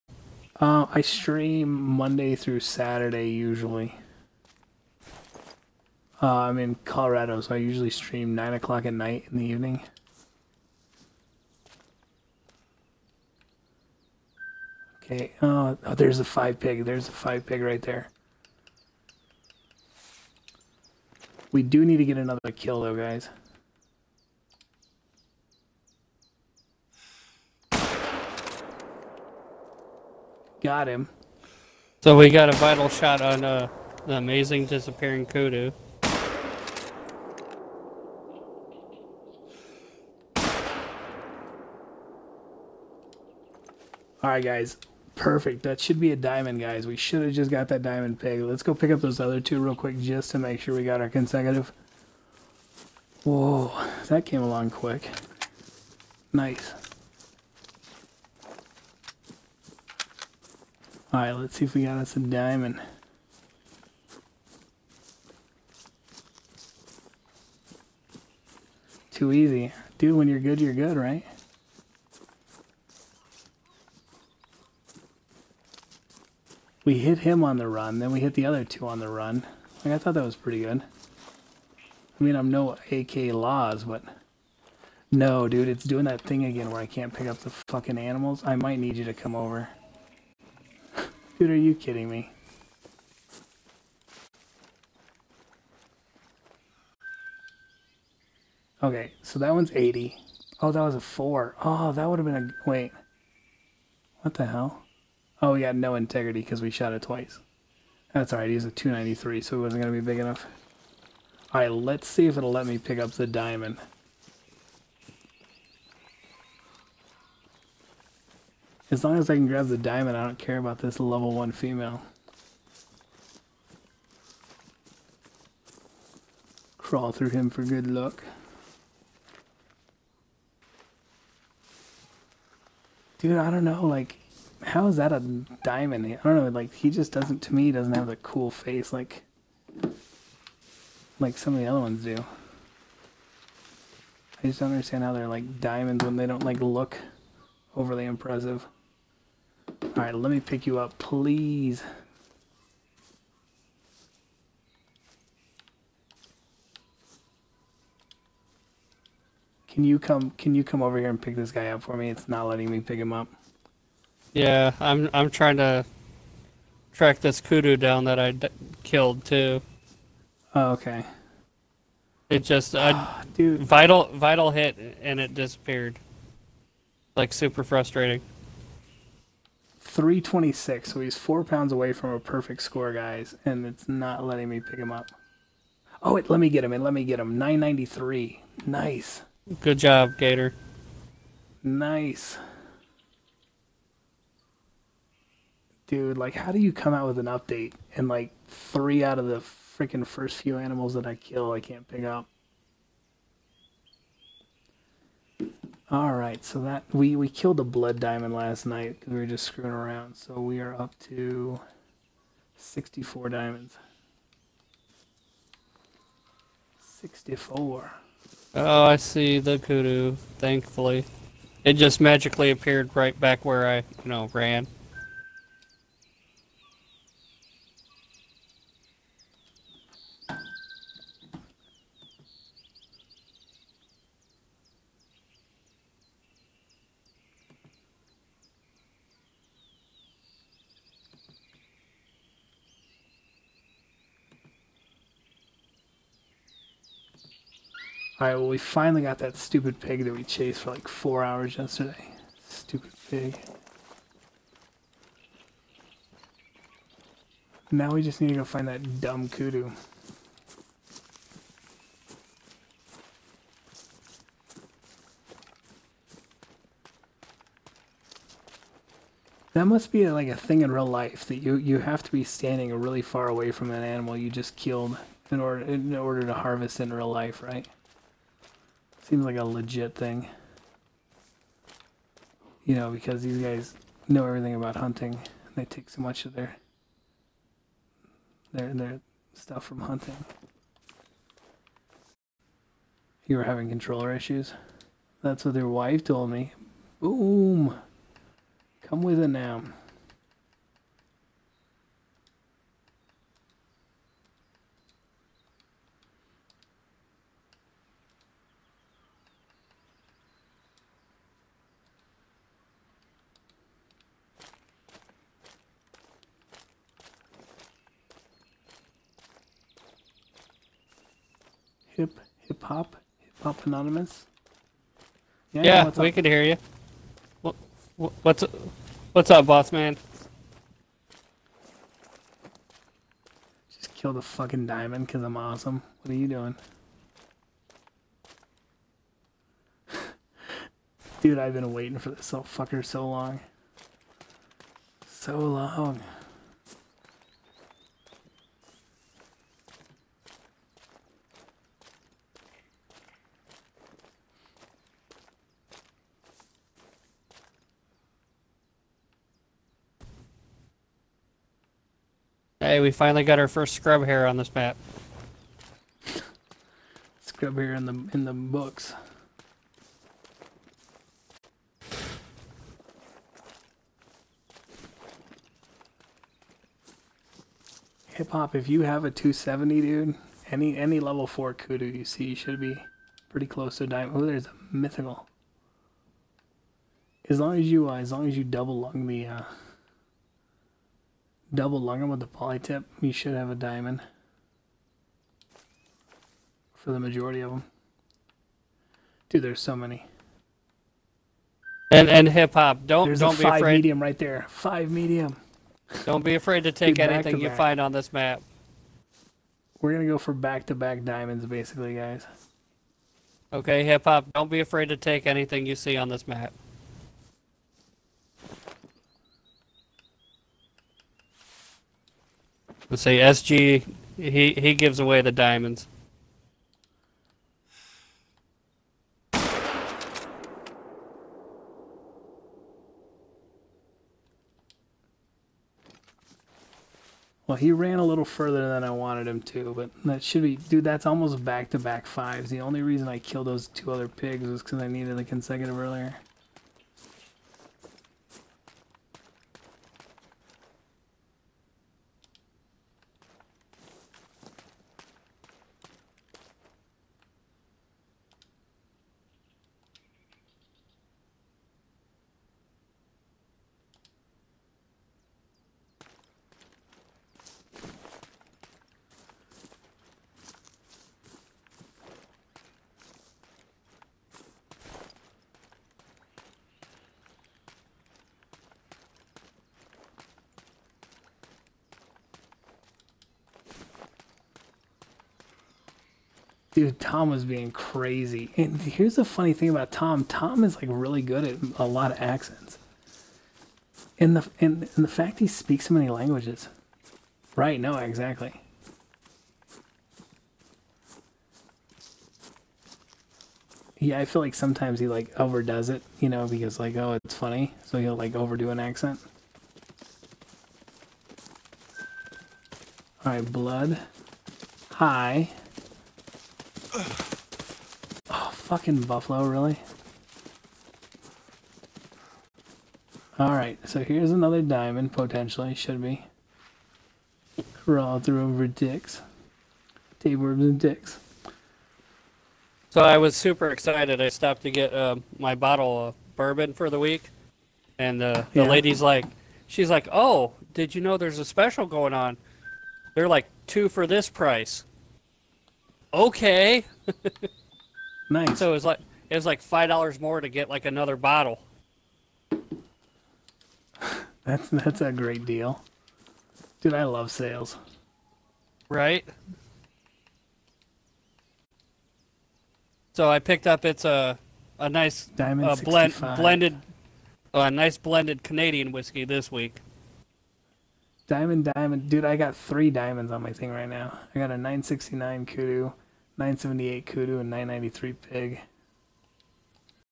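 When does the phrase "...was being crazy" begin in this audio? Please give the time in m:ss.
8:07.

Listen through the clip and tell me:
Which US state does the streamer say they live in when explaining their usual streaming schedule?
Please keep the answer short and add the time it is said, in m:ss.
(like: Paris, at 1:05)
Colorado, at 0:06.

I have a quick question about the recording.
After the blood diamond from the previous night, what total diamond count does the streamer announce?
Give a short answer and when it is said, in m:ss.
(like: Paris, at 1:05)
64, at 3:32.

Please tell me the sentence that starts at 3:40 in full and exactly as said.
Thankfully, it just magically appeared right back where I, you know, ran.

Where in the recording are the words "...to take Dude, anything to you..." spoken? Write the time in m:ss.
6:46.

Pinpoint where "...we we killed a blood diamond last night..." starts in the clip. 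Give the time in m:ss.
3:26.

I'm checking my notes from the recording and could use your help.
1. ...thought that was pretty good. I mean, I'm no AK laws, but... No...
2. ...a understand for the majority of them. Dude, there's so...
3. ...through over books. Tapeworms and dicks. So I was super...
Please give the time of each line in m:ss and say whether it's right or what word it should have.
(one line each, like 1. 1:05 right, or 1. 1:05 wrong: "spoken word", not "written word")
1. 1:19 right
2. 6:33 wrong: "diamond", not "understand"
3. 8:48 wrong: "dicks", not "books".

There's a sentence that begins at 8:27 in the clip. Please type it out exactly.
So he'll like overdo an accent.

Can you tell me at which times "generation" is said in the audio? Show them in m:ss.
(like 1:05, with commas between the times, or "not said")
not said.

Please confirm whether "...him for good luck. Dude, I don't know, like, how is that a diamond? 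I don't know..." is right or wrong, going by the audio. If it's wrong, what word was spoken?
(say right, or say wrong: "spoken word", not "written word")
right.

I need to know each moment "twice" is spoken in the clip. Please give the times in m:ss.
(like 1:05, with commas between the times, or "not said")
1:47.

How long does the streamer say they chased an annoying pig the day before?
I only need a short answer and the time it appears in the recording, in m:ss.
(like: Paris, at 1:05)
4 hours, at 4:10.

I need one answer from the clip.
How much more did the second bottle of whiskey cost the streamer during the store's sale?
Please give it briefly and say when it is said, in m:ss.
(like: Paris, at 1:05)
5 dollars, at 9:09.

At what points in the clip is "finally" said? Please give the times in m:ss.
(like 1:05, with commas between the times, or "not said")
4:08, 6:02.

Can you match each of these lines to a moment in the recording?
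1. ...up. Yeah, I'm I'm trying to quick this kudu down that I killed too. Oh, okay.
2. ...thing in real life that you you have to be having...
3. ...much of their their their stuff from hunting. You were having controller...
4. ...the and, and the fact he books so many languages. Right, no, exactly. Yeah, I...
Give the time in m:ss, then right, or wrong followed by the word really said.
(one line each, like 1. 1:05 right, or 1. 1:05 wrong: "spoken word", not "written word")
1. 2:43 wrong: "track", not "quick"
2. 4:30 wrong: "standing", not "having"
3. 4:46 right
4. 8:14 wrong: "speaks", not "books".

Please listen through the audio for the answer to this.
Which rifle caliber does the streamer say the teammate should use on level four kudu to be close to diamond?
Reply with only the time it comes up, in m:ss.
6:19.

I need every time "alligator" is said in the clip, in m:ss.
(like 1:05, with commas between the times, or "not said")
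not said.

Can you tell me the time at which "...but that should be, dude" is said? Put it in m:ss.
7:19.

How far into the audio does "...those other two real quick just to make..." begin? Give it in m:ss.
0:49.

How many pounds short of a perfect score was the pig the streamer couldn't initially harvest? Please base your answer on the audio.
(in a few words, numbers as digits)
4.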